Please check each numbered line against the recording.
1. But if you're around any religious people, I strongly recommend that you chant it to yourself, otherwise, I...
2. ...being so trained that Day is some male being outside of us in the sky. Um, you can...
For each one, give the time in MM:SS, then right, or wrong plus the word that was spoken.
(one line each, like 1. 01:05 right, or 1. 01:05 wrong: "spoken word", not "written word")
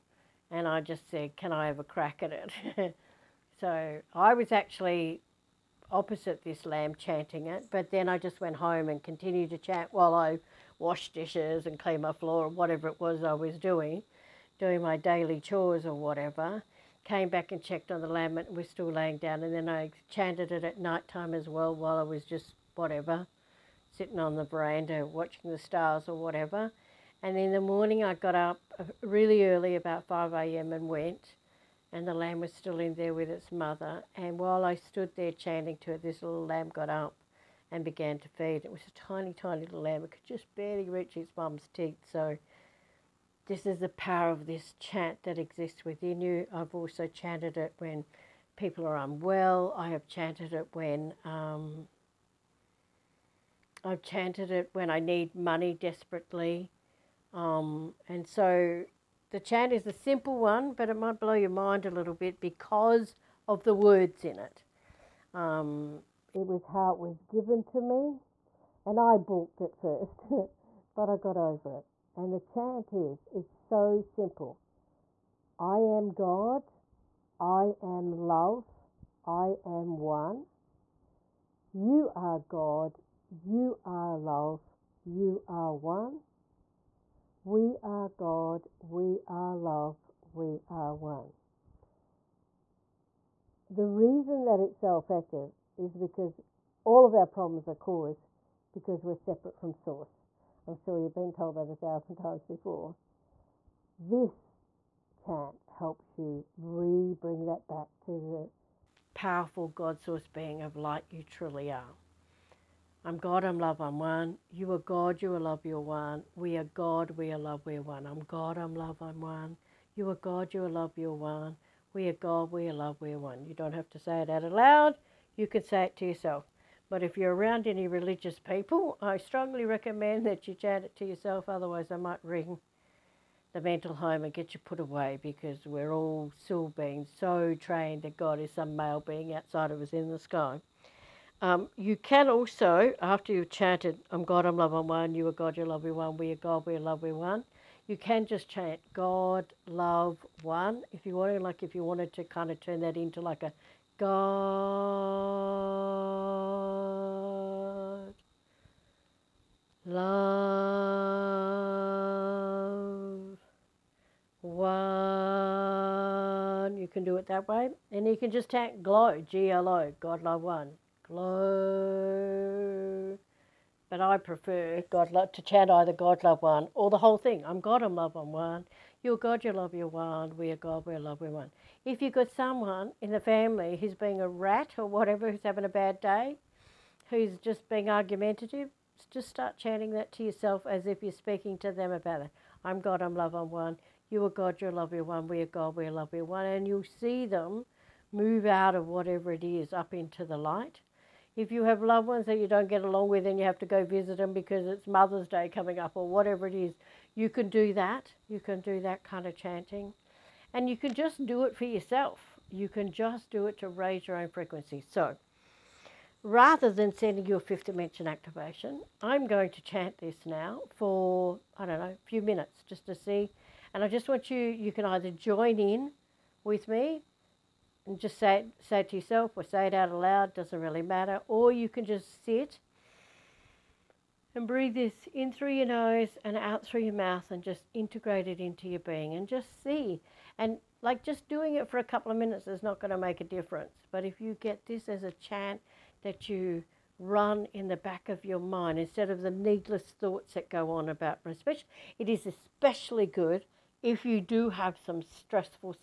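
1. 02:06 right
2. 02:16 wrong: "God", not "Day".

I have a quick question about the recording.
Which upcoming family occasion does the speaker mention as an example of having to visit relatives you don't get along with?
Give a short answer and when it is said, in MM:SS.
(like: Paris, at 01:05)
Mother's Day, at 03:24.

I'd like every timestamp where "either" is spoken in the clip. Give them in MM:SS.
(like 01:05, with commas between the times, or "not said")
02:55, 03:44.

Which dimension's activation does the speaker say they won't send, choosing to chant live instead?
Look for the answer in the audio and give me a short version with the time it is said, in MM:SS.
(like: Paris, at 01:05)
fifth dimension, at 03:37.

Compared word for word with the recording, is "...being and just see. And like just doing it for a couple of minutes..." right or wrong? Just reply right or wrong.
right.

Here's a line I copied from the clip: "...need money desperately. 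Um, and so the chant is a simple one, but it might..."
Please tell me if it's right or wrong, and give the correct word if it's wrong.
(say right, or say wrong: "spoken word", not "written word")
right.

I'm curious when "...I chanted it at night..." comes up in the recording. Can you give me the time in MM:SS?
00:19.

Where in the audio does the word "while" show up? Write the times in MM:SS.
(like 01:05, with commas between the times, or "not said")
00:09, 00:21, 00:34.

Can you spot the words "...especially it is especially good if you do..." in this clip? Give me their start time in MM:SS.
04:11.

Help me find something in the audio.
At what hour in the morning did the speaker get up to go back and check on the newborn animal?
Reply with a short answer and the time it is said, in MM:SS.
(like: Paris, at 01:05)
5 a.m., at 00:29.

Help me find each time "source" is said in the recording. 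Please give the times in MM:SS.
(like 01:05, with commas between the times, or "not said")
01:39, 01:50.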